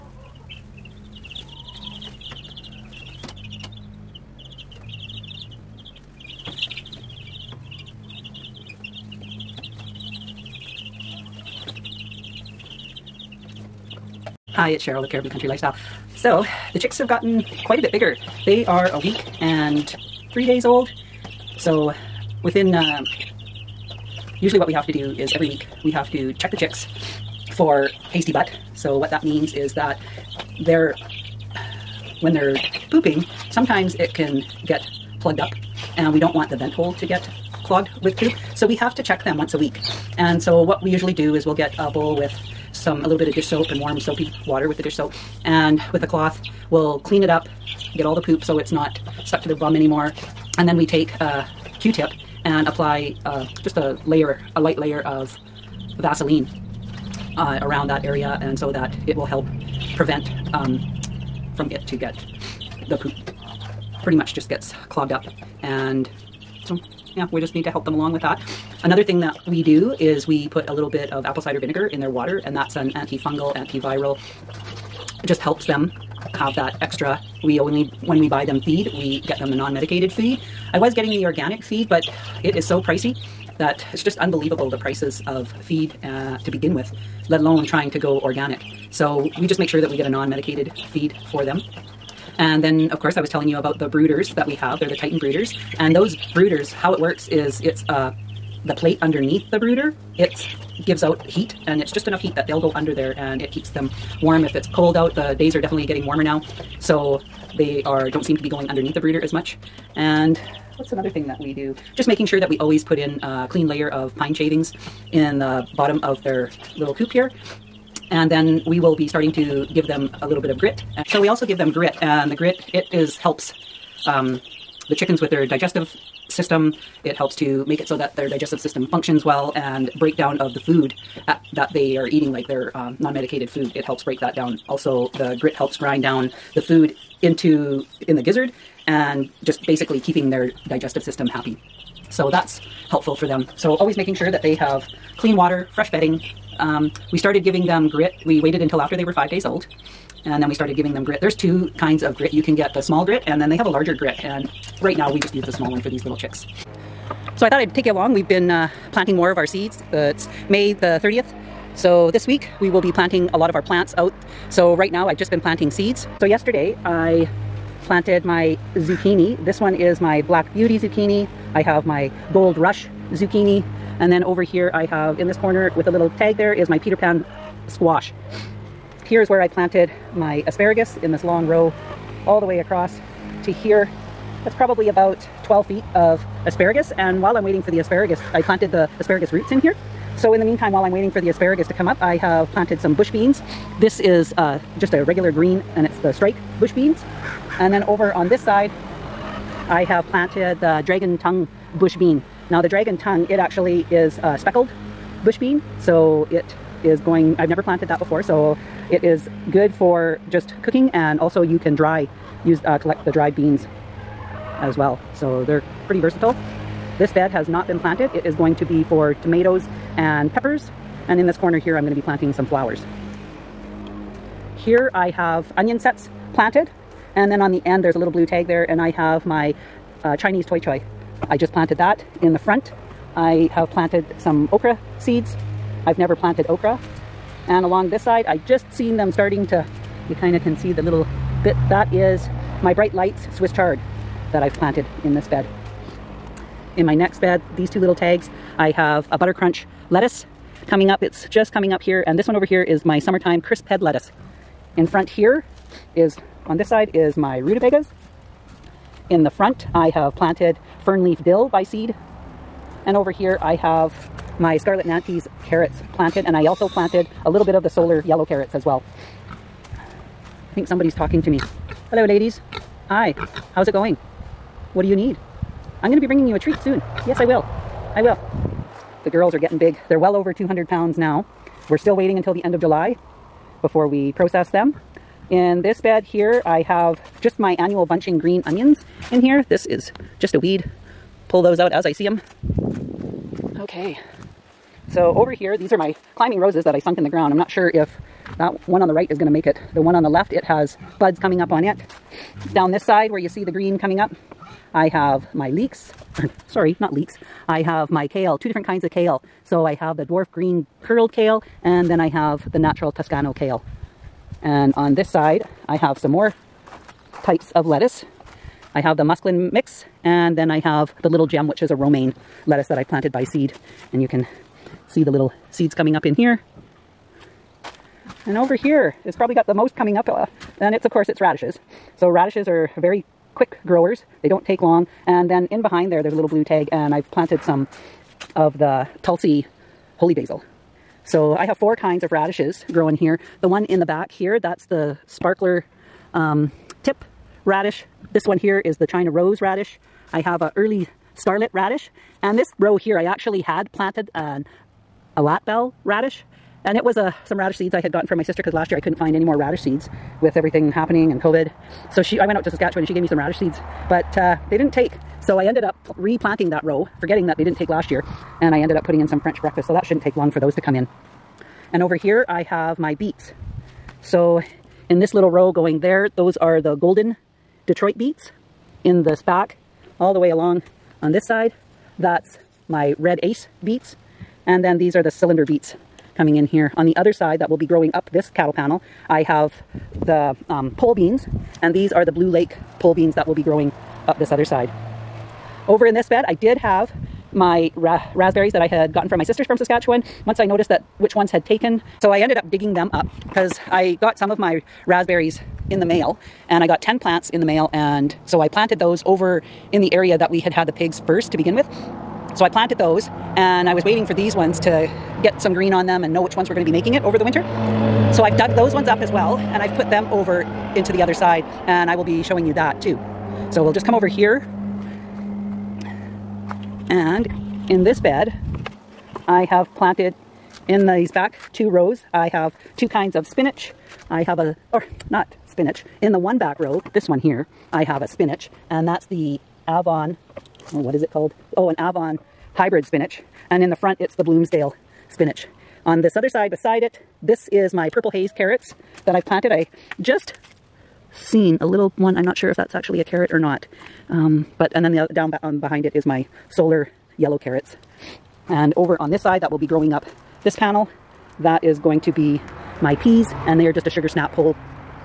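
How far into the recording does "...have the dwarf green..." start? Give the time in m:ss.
5:09.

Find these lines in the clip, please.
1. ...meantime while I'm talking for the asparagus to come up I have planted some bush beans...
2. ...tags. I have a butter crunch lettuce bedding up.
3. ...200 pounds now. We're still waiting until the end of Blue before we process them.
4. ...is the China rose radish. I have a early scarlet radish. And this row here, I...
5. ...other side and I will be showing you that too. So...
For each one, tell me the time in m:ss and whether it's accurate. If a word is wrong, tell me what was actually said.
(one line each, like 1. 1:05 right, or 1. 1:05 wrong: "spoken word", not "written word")
1. 3:10 wrong: "waiting", not "talking"
2. 4:07 wrong: "coming", not "bedding"
3. 4:40 wrong: "July", not "Blue"
4. 5:48 right
5. 7:01 right.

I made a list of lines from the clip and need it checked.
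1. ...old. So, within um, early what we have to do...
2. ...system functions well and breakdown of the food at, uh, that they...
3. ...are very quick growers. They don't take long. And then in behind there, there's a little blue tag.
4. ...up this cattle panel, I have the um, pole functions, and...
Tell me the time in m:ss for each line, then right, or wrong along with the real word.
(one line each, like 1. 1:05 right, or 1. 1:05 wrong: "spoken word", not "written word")
1. 0:20 wrong: "usually", not "early"
2. 2:08 right
3. 5:32 right
4. 6:27 wrong: "beans", not "functions".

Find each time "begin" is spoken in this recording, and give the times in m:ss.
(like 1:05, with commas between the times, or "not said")
1:26, 6:51.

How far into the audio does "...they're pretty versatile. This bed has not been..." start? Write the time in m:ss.
3:35.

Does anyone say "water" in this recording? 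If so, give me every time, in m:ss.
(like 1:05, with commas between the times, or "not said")
0:44, 1:12, 2:25.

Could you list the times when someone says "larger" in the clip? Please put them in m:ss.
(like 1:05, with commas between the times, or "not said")
2:33.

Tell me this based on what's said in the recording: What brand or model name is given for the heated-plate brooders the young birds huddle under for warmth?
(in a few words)
Titan.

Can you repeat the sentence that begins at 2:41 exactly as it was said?
So this week we will be planting a lot of our plants out.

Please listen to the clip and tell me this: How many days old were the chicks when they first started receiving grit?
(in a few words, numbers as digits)
5.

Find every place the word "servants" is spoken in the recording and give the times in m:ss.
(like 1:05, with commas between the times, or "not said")
not said.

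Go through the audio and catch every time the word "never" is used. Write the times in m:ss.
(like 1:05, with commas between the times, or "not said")
3:27, 3:55.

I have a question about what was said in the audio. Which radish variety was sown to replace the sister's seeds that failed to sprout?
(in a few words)
French breakfast.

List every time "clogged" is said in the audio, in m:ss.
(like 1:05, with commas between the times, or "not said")
0:37, 1:04.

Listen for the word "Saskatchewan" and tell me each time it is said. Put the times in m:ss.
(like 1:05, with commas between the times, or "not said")
6:02, 6:39.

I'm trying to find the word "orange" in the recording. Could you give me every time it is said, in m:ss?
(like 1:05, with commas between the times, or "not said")
not said.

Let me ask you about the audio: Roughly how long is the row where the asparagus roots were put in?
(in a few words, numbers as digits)
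12 feet.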